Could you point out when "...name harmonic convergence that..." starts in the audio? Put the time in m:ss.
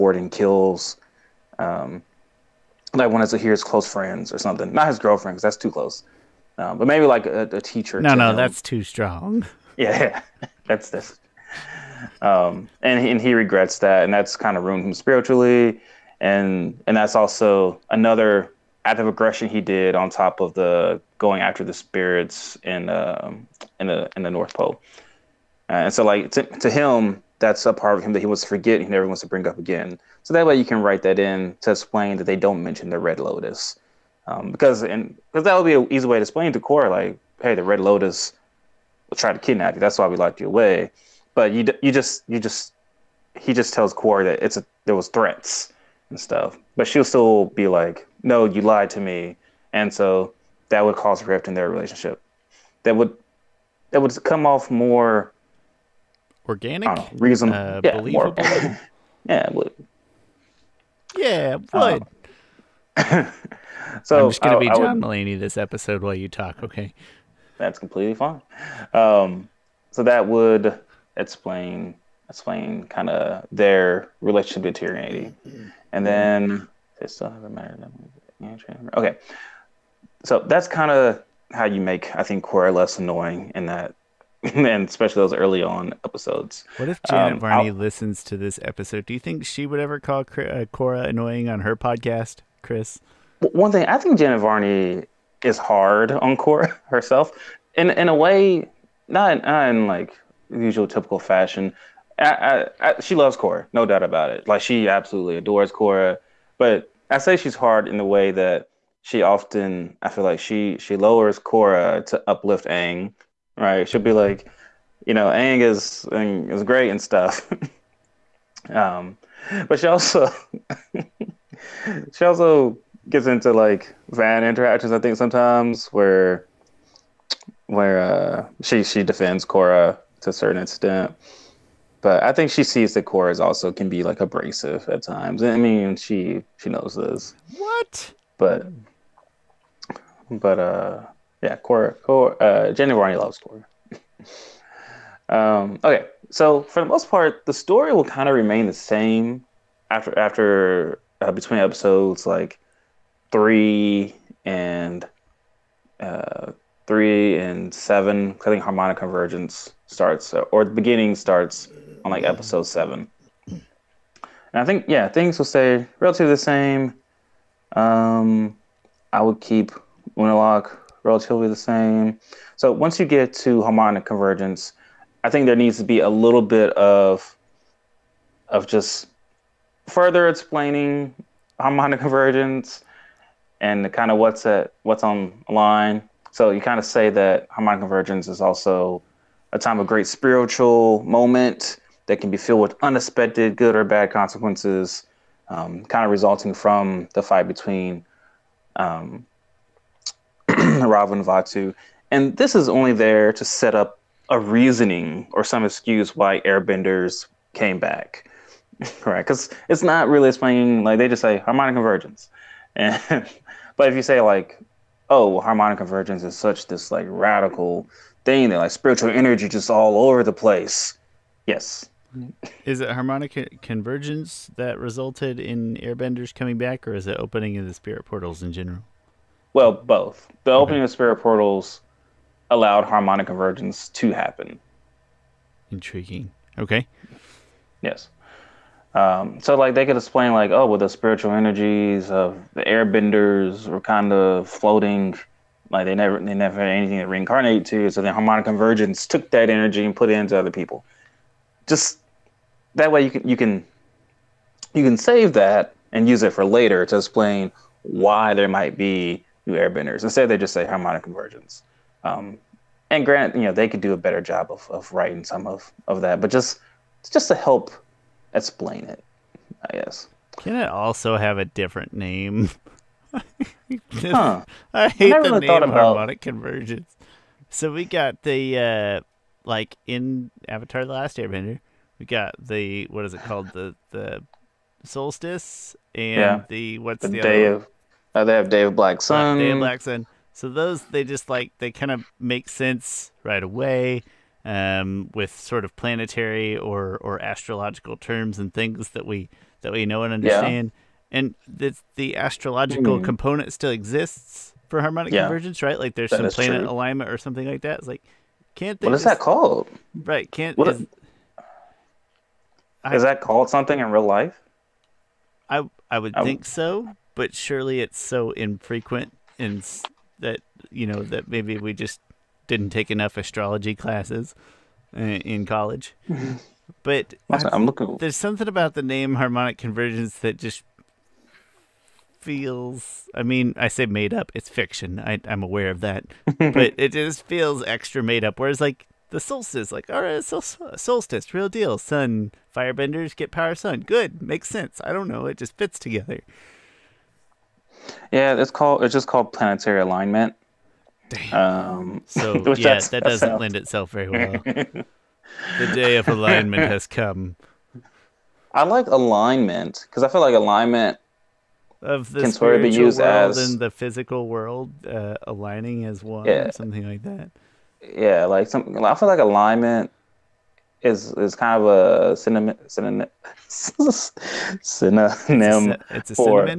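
5:28.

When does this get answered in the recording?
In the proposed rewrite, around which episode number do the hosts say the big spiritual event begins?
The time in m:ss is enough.
2:42.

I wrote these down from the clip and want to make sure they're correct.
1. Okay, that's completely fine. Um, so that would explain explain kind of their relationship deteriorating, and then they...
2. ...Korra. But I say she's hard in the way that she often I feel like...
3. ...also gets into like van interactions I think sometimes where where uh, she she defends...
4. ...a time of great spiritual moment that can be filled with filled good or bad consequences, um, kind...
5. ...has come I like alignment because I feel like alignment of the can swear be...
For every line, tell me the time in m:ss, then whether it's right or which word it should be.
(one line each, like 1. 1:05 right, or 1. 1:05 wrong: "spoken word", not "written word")
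1. 1:06 right
2. 1:45 right
3. 2:02 right
4. 3:09 wrong: "unexpected", not "filled"
5. 5:56 right.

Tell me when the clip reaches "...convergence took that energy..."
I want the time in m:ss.
4:08.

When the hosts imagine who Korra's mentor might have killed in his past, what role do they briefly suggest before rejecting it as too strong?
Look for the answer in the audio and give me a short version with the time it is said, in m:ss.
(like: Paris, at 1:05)
A teacher, at 0:07.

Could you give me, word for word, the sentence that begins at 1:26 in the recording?
What if Janet um, Varney I'll...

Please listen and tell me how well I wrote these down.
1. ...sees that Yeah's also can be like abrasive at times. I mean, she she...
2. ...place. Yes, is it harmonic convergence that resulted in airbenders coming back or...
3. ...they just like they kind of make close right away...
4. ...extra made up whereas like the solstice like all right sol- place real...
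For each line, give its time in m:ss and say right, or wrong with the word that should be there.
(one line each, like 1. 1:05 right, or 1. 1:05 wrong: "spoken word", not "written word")
1. 2:12 wrong: "Korra", not "Yeah"
2. 3:40 right
3. 4:50 wrong: "sense", not "close"
4. 5:37 wrong: "solstice", not "place".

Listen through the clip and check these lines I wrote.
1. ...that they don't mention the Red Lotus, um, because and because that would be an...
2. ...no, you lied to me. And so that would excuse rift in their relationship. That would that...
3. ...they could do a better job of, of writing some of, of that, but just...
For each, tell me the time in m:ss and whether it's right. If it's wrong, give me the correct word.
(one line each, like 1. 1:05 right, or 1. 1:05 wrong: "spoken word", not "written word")
1. 0:32 right
2. 0:48 wrong: "cause", not "excuse"
3. 4:23 right.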